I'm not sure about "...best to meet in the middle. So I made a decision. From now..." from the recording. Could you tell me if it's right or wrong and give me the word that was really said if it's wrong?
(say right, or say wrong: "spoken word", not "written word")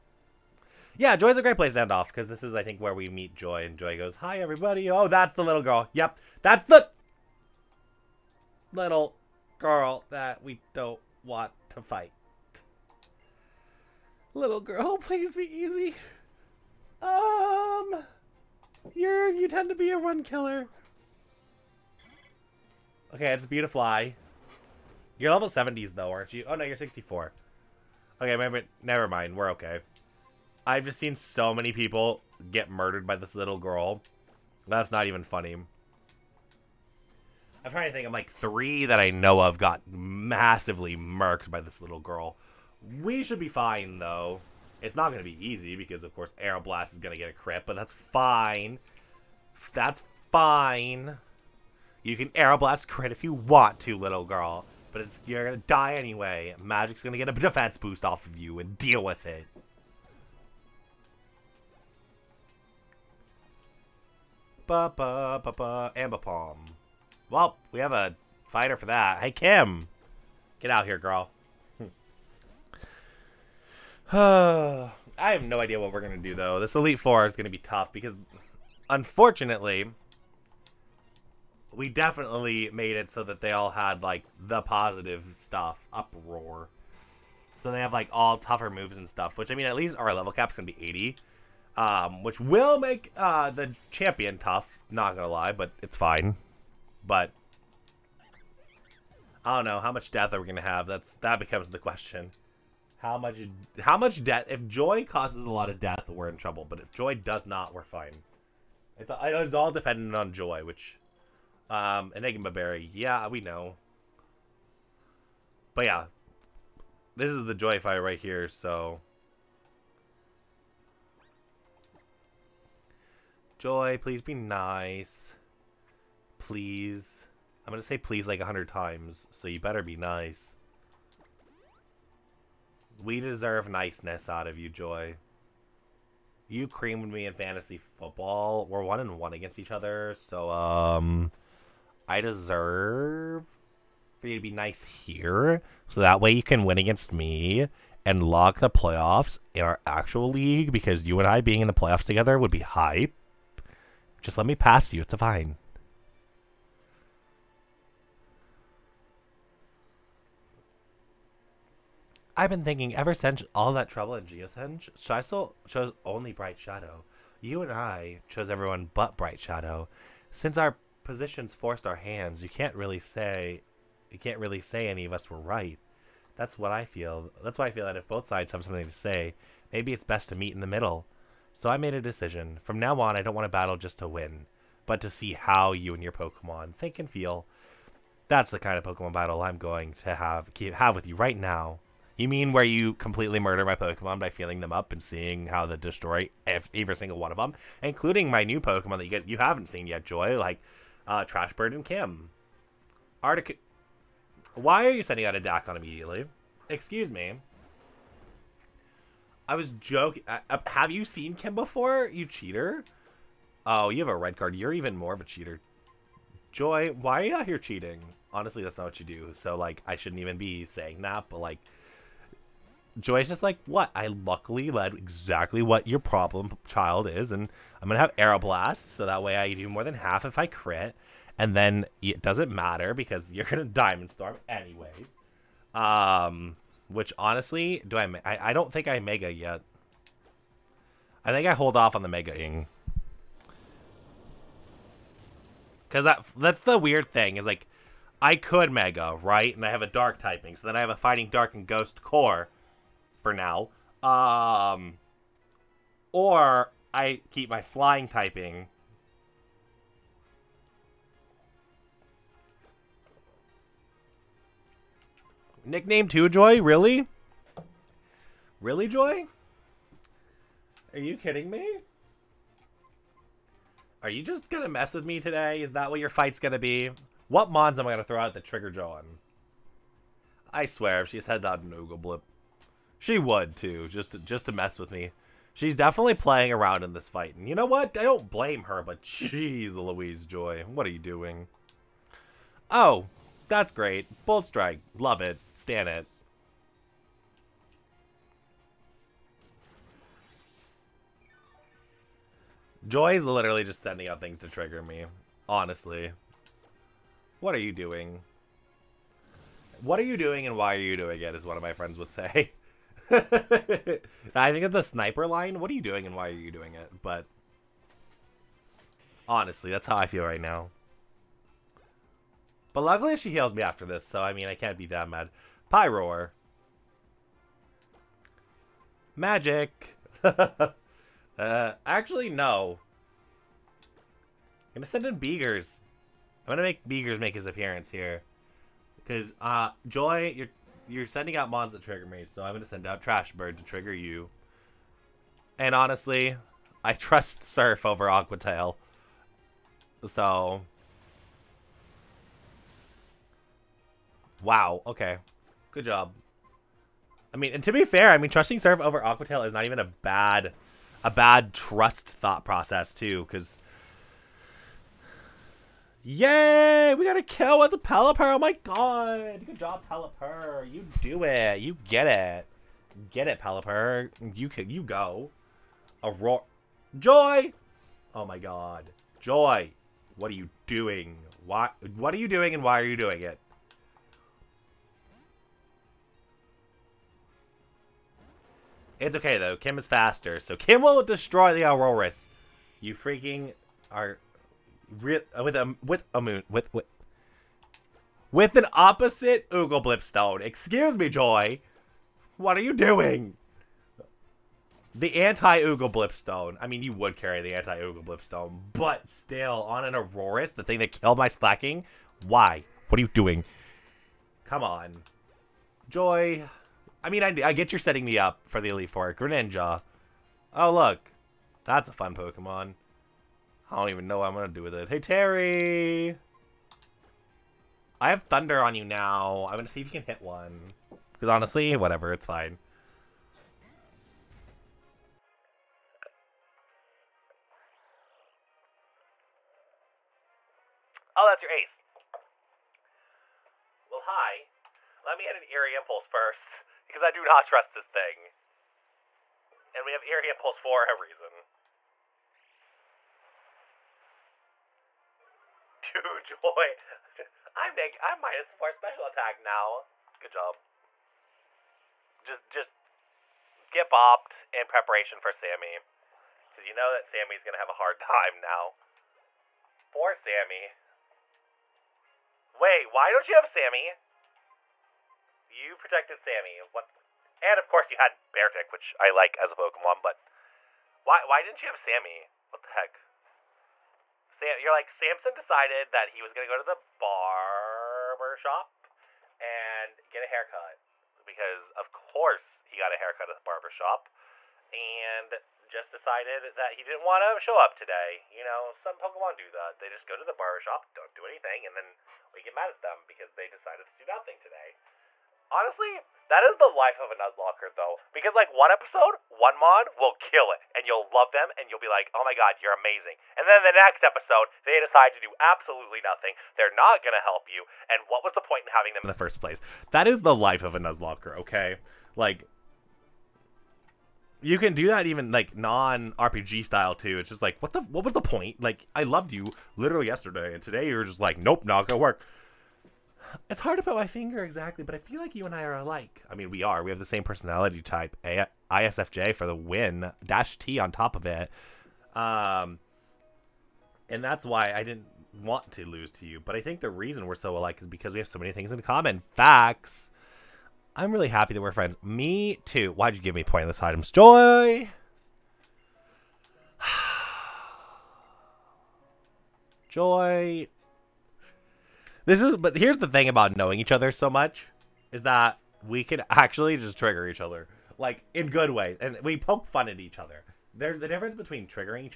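right.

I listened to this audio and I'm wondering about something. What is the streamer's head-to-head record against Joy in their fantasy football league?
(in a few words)
One and one.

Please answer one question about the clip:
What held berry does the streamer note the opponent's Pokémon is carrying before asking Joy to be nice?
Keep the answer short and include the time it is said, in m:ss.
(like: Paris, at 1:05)
Enigma Berry, at 1:52.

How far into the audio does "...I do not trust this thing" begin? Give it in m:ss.
7:27.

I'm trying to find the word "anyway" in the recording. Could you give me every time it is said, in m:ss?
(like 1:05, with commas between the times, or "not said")
0:55, 3:54.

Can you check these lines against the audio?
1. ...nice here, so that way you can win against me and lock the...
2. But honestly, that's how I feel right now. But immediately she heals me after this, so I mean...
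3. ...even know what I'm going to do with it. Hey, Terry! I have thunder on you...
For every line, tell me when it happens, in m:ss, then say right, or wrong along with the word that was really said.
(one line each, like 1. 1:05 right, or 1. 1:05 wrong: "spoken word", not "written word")
1. 2:24 right
2. 5:17 wrong: "luckily", not "immediately"
3. 7:03 right.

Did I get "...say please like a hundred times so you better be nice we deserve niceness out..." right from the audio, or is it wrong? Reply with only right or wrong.
right.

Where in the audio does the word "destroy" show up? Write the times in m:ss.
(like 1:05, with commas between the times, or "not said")
3:15, 6:31.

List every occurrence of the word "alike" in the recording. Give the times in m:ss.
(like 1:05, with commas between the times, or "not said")
8:55, 9:07.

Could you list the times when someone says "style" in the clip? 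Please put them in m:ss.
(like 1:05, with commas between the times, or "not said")
8:46.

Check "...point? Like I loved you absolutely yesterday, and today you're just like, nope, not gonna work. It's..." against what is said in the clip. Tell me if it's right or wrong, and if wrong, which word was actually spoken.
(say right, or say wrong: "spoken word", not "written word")
wrong: "literally", not "absolutely".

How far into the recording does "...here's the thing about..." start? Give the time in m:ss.
9:22.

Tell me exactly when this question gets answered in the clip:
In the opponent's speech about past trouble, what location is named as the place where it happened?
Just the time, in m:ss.
2:44.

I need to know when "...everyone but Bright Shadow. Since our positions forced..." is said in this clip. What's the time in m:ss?
2:48.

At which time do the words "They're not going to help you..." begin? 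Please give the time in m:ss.
8:36.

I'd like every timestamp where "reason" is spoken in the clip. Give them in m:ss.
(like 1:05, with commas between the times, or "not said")
7:30, 9:06.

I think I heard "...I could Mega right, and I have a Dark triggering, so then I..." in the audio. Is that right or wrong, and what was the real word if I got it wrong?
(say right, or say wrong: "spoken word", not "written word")
wrong: "typing", not "triggering".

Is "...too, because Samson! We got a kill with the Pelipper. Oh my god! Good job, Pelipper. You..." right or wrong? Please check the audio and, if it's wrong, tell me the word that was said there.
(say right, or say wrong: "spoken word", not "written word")
wrong: "Yay", not "Samson".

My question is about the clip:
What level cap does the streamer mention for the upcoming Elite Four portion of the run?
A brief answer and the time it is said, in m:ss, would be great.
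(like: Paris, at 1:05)
80, at 1:30.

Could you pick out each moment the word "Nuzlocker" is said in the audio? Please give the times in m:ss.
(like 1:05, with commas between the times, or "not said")
8:27, 8:40.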